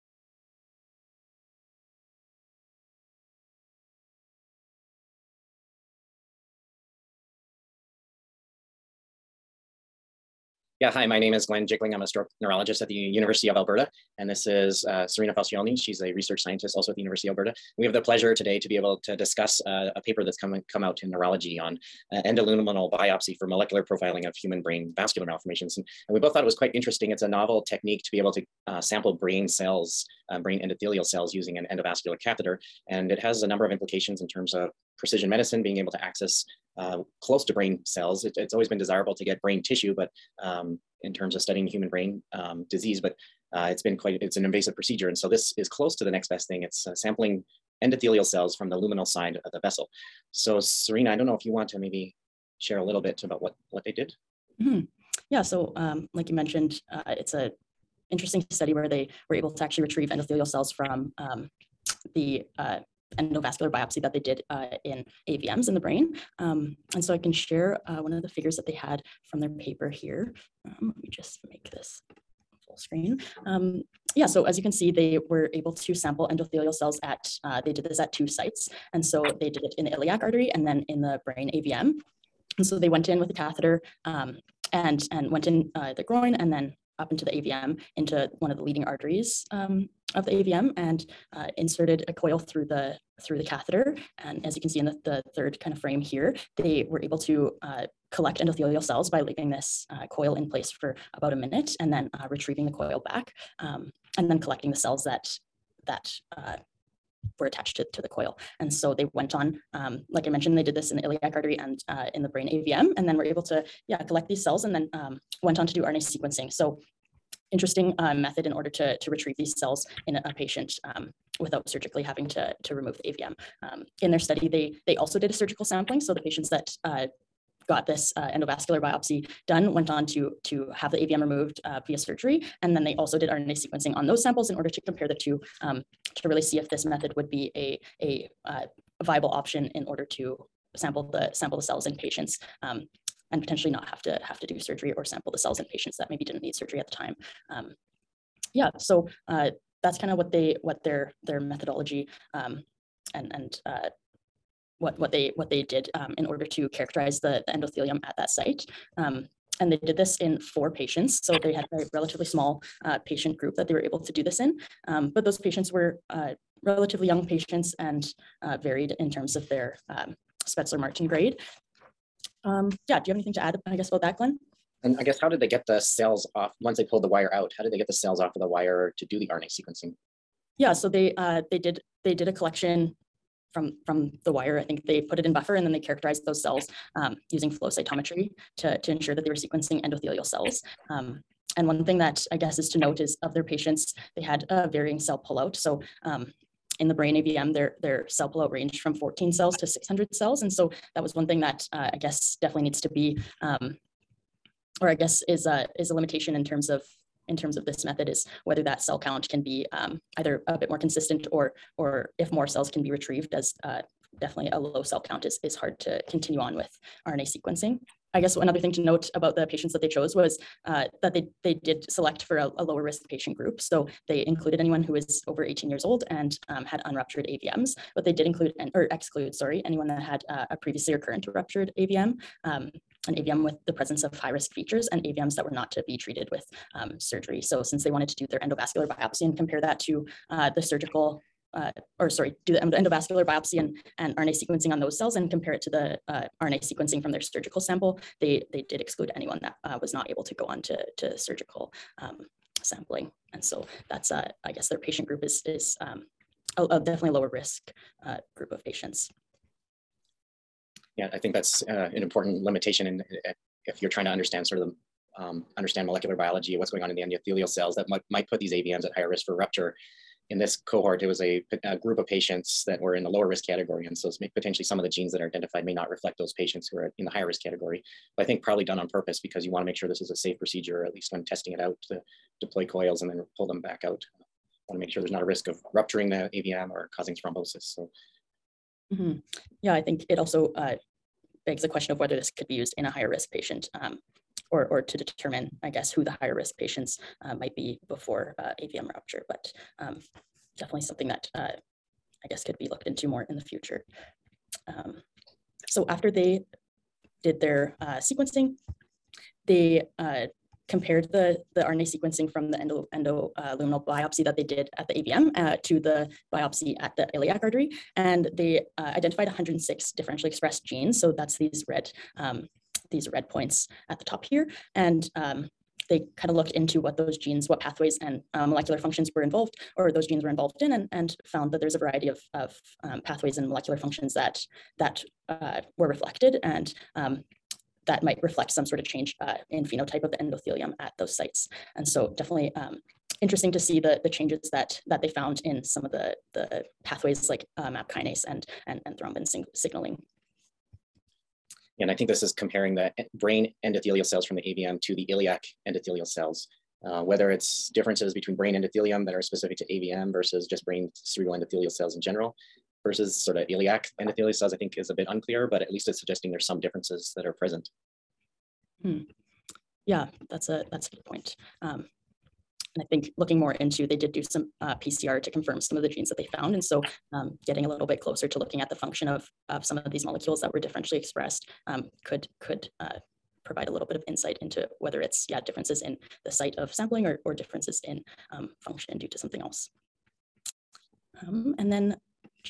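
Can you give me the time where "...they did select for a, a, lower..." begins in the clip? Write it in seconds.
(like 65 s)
221 s.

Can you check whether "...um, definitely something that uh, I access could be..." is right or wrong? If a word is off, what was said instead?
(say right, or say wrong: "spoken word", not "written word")
wrong: "guess", not "access".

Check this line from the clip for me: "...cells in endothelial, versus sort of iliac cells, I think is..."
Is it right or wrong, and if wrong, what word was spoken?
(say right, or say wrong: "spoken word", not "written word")
wrong: "general", not "endothelial".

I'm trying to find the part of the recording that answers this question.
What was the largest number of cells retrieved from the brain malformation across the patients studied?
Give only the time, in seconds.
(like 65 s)
199 s.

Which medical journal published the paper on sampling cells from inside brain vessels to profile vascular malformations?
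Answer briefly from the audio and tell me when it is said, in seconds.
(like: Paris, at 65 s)
Neurology, at 21 s.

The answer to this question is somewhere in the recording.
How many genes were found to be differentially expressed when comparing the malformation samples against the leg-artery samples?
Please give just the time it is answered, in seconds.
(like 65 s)
319 s.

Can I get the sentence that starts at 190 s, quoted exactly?
Um, and one thing that I guess is to note is of their patients, they had a varying cell pullout.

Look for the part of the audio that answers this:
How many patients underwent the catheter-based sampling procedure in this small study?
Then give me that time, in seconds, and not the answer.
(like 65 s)
160 s.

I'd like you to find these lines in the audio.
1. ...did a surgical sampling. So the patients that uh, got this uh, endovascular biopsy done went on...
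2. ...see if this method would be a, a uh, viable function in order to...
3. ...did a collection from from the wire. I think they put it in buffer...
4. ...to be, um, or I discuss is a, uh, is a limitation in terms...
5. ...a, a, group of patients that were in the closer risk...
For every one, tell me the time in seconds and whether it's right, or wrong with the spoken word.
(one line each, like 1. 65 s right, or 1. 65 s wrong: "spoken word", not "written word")
1. 125 s right
2. 136 s wrong: "option", not "function"
3. 182 s right
4. 202 s wrong: "guess", not "discuss"
5. 271 s wrong: "lower", not "closer".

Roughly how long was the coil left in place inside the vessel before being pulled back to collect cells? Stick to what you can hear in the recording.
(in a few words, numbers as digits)
About a minute.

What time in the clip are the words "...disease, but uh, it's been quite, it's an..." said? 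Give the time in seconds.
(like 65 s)
42 s.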